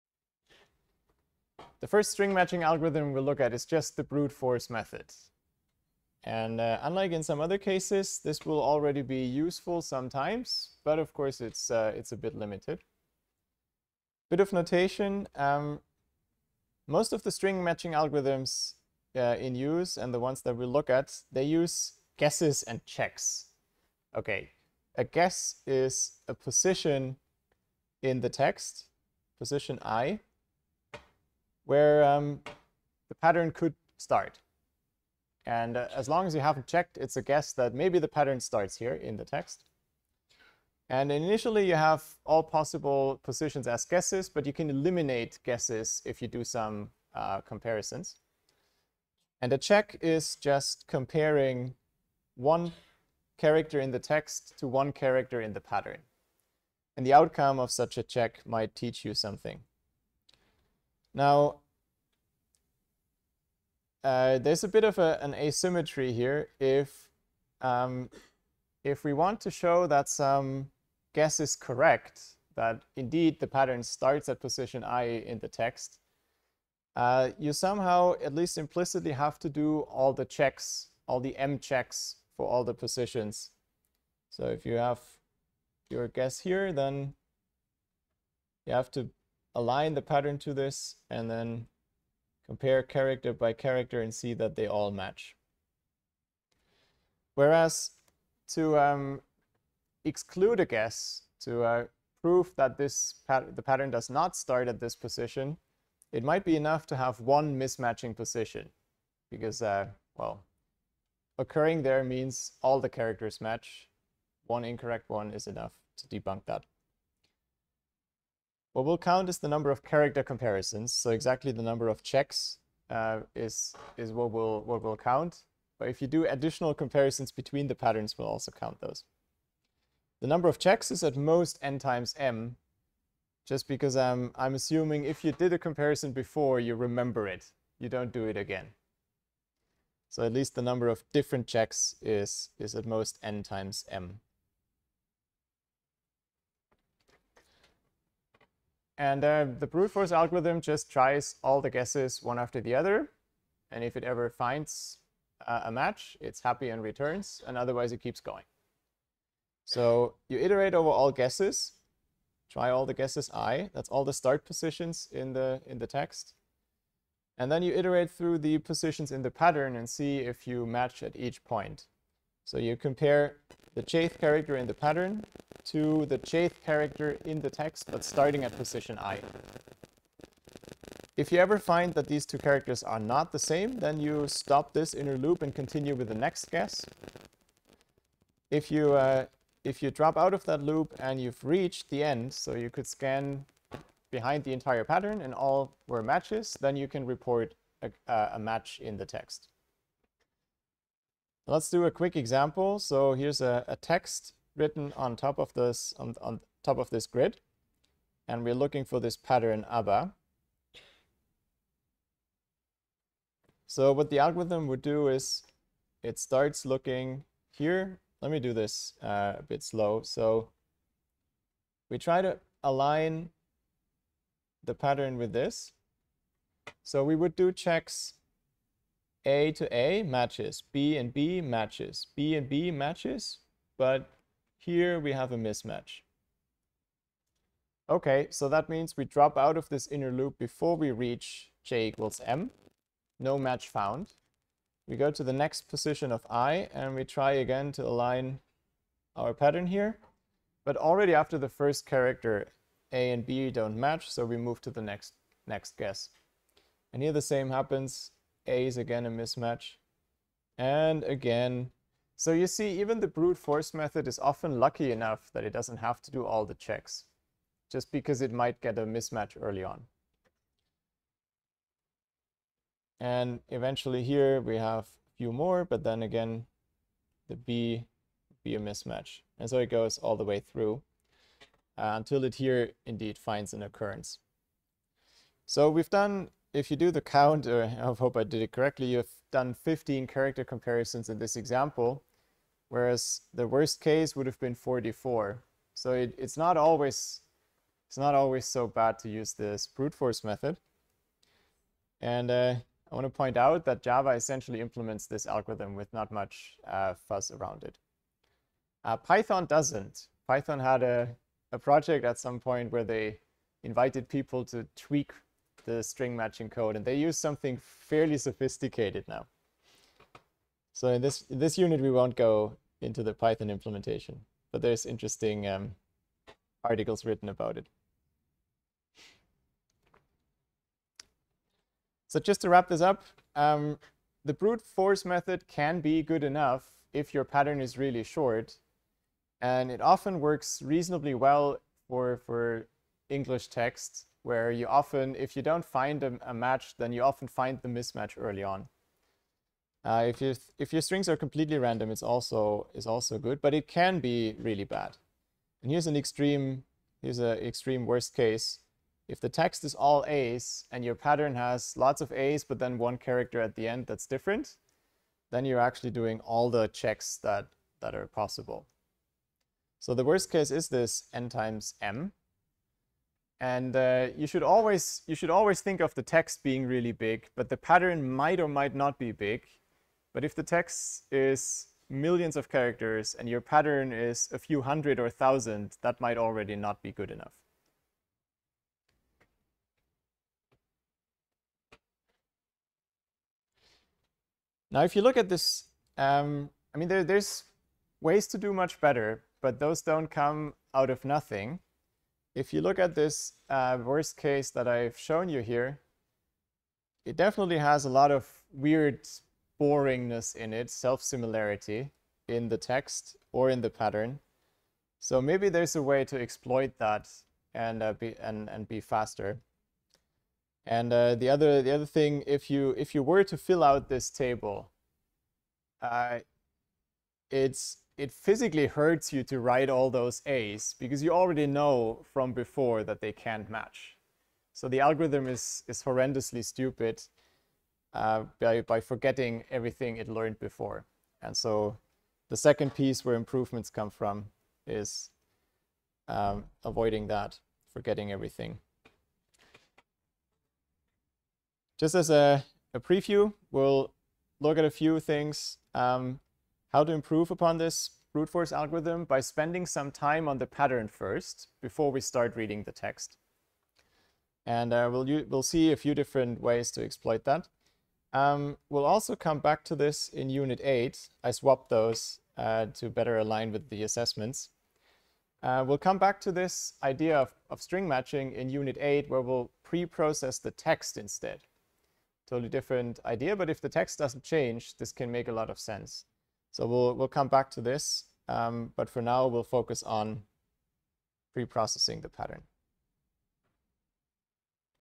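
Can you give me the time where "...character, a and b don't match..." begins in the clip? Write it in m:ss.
4:11.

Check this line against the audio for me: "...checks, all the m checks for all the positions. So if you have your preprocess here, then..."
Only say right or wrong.
wrong.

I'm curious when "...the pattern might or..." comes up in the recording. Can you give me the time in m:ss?
6:17.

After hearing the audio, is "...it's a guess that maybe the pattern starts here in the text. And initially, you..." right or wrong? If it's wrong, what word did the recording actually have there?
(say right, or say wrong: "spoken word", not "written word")
right.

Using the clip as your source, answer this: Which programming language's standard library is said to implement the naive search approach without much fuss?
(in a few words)
Java.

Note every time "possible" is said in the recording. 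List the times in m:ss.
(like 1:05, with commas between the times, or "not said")
0:42, 6:08.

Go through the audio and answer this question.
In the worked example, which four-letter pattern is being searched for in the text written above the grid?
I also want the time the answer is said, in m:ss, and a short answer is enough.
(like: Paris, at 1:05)
ABBA, at 3:29.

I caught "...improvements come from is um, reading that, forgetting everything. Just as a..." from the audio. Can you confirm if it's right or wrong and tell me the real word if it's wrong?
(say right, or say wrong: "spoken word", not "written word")
wrong: "avoiding", not "reading".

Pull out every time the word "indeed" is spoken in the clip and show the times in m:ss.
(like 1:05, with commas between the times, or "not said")
1:12, 4:42.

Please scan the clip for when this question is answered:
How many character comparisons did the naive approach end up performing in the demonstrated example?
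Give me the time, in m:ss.
4:49.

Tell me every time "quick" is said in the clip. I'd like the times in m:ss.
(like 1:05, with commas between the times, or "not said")
3:21.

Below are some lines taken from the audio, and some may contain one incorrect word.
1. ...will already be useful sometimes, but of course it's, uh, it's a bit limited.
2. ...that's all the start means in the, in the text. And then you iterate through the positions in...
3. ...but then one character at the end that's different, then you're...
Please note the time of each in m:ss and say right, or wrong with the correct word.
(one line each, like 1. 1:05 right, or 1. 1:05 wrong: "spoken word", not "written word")
1. 0:08 right
2. 2:43 wrong: "positions", not "means"
3. 6:02 right.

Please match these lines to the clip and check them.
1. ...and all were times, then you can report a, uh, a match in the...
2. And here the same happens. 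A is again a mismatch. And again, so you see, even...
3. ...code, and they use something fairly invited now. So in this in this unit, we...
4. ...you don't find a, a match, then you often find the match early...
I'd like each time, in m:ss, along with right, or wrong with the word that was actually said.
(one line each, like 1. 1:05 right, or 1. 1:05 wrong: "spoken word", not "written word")
1. 3:15 wrong: "matches", not "times"
2. 4:16 right
3. 5:16 wrong: "sophisticated", not "invited"
4. 5:45 wrong: "mismatch", not "match".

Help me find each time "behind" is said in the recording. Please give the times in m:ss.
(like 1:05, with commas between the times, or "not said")
3:14.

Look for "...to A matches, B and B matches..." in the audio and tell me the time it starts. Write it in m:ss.
3:49.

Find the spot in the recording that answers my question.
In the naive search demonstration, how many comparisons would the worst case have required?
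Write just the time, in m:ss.
4:54.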